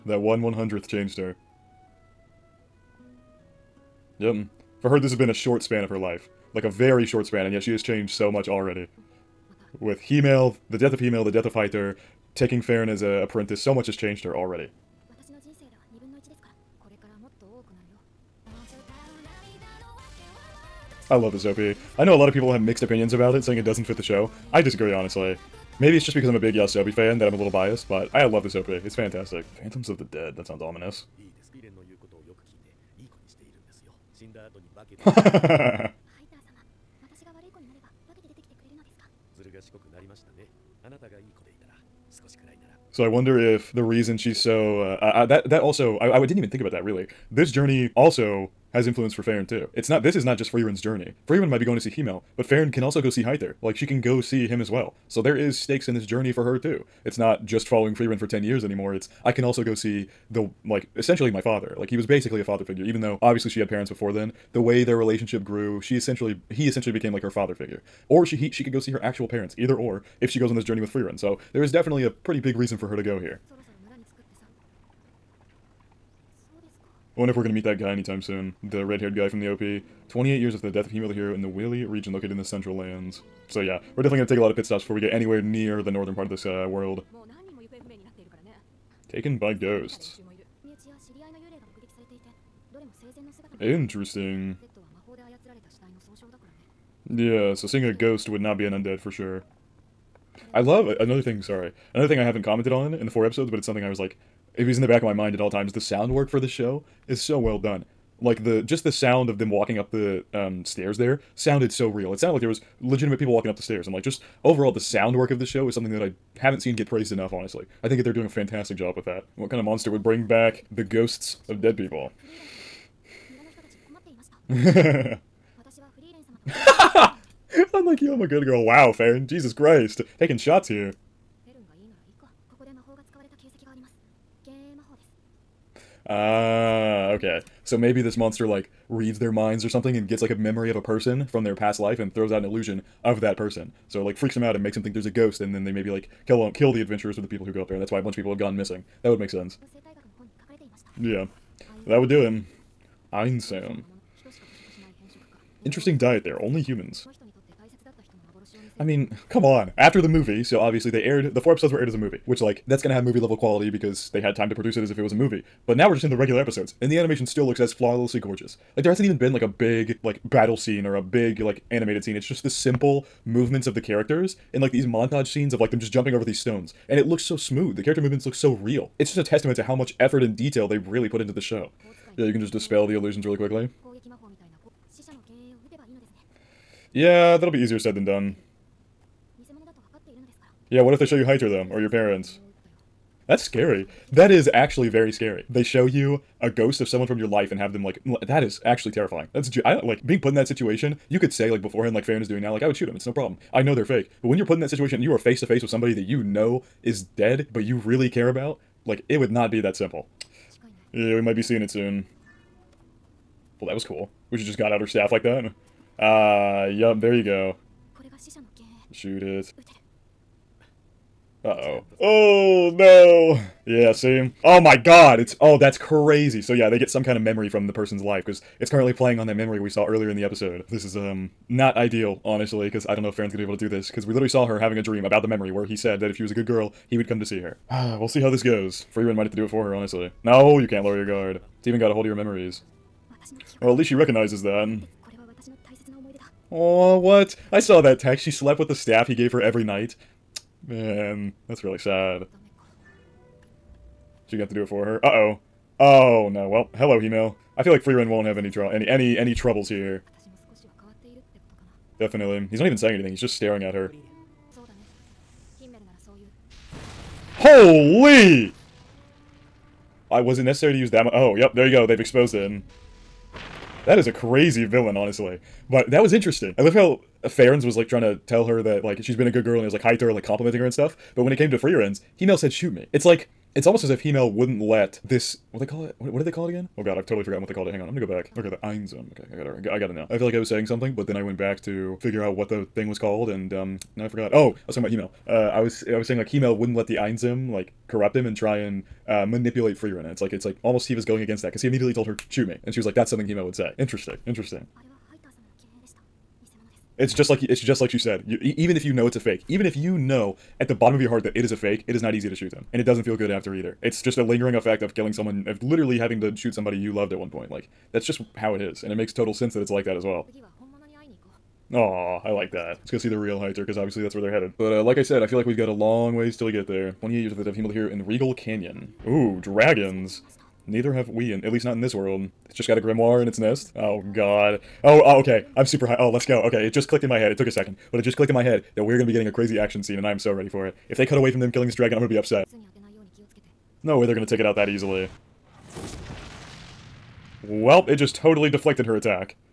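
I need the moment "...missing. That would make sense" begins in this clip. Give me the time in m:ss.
2:28.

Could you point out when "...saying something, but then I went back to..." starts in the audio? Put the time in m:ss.
4:50.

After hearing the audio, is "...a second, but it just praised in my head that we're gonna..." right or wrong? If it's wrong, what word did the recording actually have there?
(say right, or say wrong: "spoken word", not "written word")
wrong: "clicked", not "praised".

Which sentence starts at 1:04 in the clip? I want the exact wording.
The way their relationship grew, she essentially he essentially became like her father figure.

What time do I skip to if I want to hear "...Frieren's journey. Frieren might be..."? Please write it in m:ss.
0:50.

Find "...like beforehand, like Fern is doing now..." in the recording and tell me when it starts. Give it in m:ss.
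3:21.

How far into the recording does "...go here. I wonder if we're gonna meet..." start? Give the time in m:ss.
1:13.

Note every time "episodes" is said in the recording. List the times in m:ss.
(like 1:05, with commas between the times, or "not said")
1:43, 2:41, 2:46, 3:50.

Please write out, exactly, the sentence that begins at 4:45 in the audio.
What, what did they call it again?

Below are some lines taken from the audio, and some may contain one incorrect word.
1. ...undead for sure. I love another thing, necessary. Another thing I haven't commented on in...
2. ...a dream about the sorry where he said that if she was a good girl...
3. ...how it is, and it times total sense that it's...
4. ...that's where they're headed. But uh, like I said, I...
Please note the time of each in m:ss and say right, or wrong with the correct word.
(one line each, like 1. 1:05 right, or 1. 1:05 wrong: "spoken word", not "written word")
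1. 1:38 wrong: "sorry", not "necessary"
2. 3:54 wrong: "memory", not "sorry"
3. 5:18 wrong: "makes", not "times"
4. 5:24 right.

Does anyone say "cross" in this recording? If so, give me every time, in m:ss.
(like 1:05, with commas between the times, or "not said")
not said.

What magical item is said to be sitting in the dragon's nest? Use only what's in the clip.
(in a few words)
A grimoire.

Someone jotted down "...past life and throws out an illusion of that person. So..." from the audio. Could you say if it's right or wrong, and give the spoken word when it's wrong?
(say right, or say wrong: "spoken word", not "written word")
right.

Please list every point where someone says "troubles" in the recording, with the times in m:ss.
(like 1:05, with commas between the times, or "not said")
4:19.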